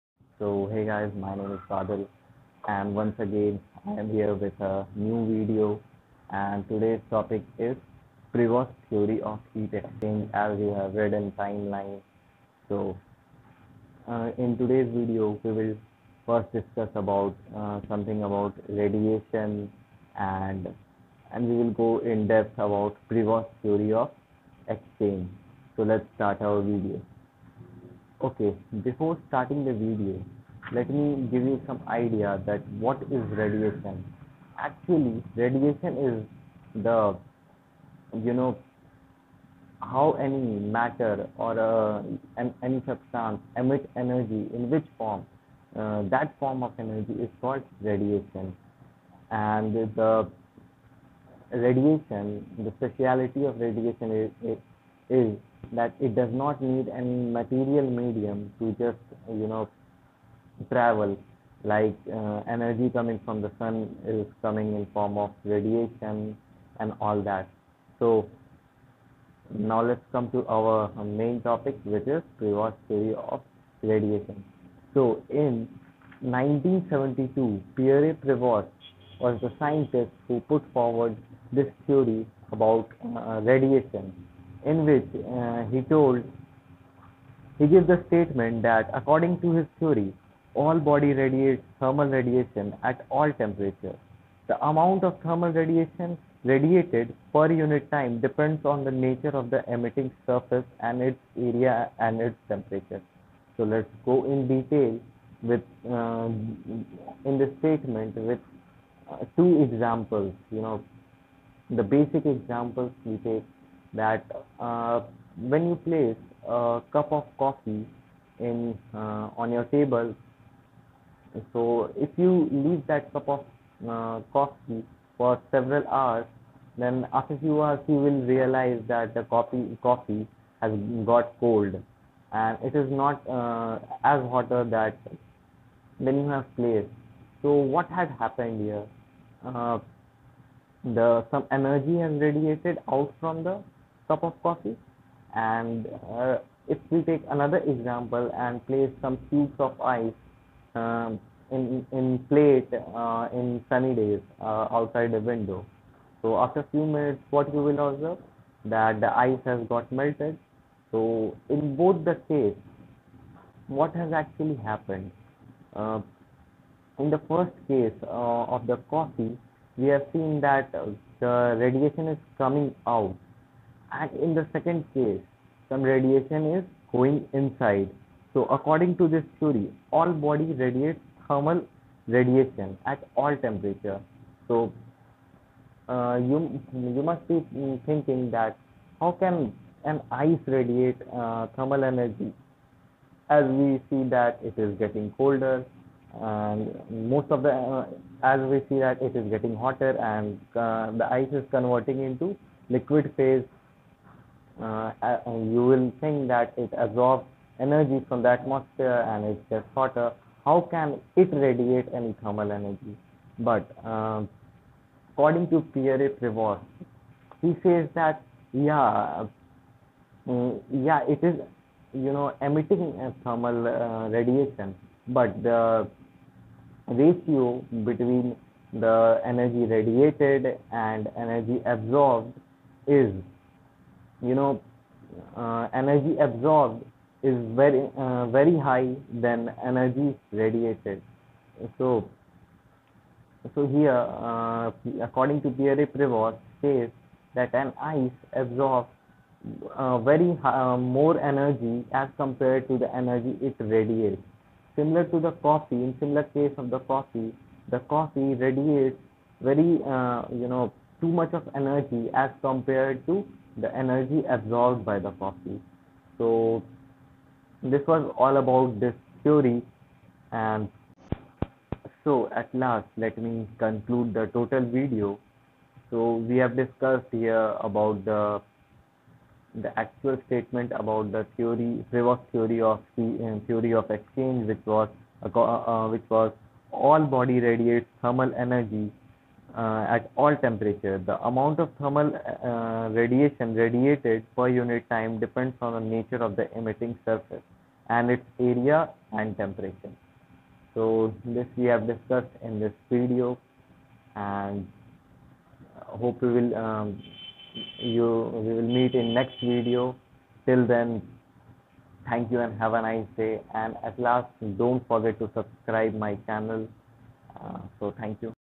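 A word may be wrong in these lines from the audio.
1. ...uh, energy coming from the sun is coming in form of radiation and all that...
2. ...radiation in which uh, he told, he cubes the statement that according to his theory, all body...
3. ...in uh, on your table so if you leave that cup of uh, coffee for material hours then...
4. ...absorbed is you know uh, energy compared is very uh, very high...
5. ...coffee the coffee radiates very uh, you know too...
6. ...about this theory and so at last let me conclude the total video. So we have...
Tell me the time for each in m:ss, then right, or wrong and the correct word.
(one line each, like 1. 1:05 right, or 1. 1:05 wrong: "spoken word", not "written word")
1. 1:02 right
2. 1:23 wrong: "gives", not "cubes"
3. 1:58 wrong: "several", not "material"
4. 3:51 wrong: "absorbed", not "compared"
5. 4:16 right
6. 4:28 right.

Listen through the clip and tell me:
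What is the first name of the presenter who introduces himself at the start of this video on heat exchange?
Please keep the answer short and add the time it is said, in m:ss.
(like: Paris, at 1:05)
Badal, at 0:01.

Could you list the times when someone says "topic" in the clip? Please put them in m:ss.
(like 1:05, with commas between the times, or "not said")
0:07, 1:11.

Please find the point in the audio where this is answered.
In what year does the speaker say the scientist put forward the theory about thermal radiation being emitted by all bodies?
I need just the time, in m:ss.
1:16.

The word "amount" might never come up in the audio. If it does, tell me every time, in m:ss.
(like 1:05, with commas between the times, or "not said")
1:34, 4:51.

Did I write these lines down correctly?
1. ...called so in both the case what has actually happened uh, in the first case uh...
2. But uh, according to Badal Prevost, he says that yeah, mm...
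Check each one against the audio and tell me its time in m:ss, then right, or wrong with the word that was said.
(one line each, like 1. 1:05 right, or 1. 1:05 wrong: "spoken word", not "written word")
1. 2:40 wrong: "melted", not "called"
2. 3:33 wrong: "Pierre", not "Badal".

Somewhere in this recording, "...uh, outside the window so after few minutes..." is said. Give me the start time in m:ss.
2:34.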